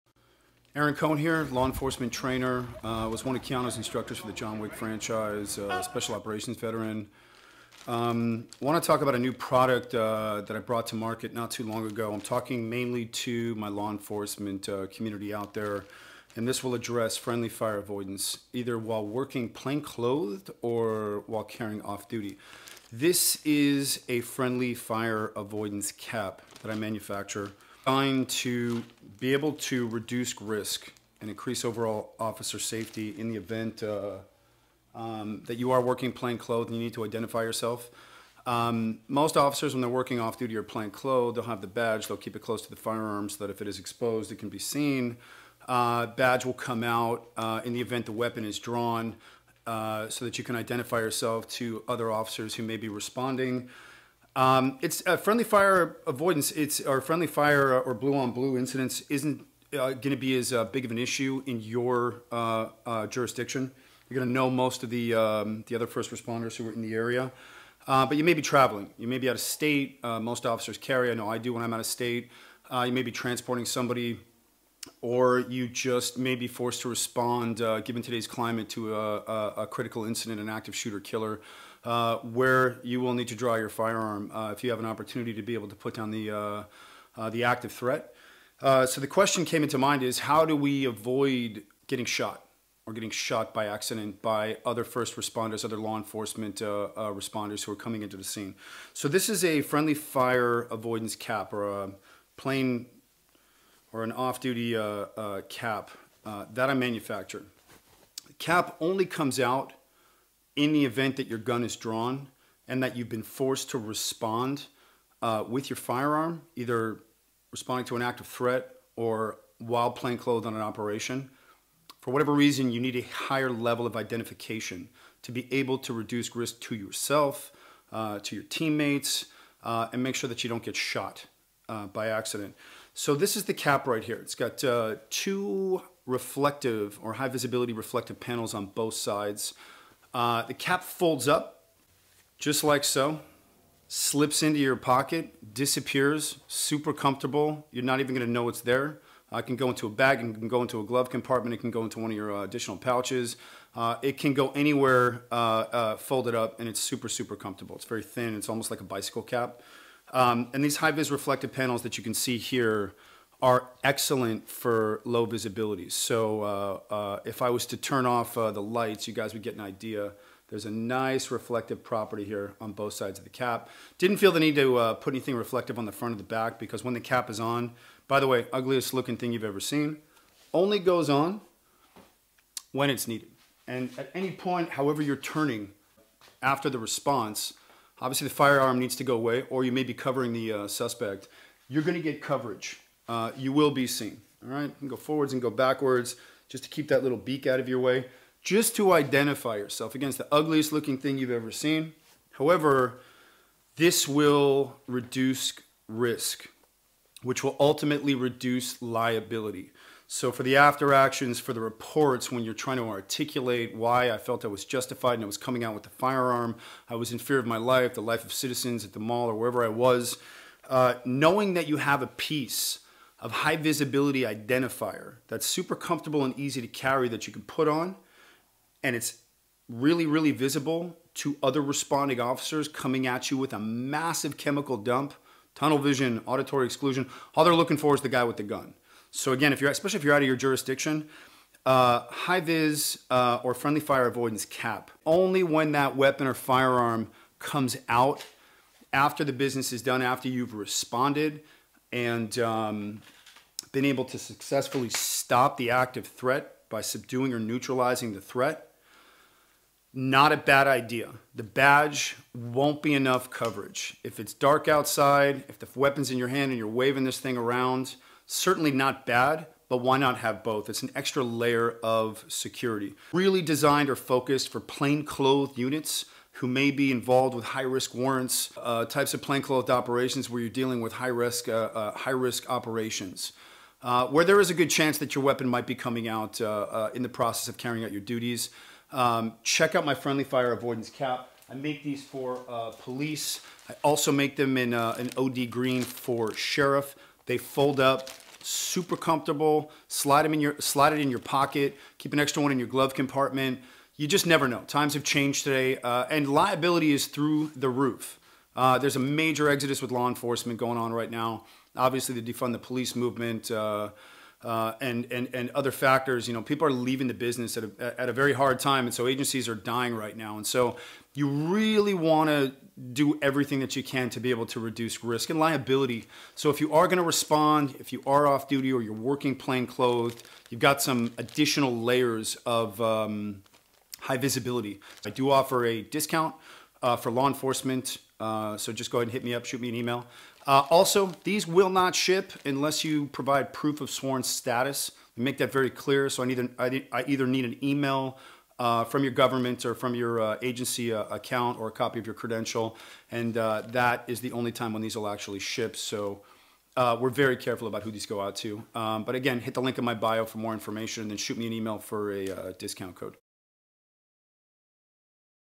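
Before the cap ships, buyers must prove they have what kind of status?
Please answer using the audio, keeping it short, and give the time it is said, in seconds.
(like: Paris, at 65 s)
sworn status, at 343 s.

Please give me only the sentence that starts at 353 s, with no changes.
And uh, that is the only time when these will actually ship.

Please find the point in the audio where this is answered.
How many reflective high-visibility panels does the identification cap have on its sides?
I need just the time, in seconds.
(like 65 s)
135 s.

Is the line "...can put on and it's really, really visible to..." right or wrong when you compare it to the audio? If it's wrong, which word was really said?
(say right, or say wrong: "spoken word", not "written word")
right.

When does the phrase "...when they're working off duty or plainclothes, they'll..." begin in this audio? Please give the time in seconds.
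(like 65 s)
39 s.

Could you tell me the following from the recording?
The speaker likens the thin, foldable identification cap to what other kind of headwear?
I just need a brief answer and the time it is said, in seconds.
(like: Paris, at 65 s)
bicycle cap, at 158 s.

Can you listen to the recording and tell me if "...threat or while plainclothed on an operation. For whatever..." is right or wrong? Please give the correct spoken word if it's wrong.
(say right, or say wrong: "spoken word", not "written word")
right.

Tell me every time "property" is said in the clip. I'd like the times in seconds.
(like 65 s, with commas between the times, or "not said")
171 s.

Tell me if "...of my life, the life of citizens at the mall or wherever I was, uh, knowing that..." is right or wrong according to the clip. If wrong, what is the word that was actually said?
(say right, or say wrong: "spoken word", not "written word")
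right.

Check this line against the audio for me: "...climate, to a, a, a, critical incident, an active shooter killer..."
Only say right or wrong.
right.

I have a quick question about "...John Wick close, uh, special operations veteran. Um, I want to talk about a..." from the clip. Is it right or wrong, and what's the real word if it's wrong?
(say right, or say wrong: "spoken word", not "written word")
wrong: "franchise", not "close".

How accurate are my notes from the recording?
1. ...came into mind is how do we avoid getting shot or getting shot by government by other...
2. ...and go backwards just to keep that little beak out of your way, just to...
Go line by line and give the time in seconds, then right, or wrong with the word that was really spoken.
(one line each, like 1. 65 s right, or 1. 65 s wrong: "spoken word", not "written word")
1. 89 s wrong: "accident", not "government"
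2. 195 s right.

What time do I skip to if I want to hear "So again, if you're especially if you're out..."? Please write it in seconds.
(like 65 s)
239 s.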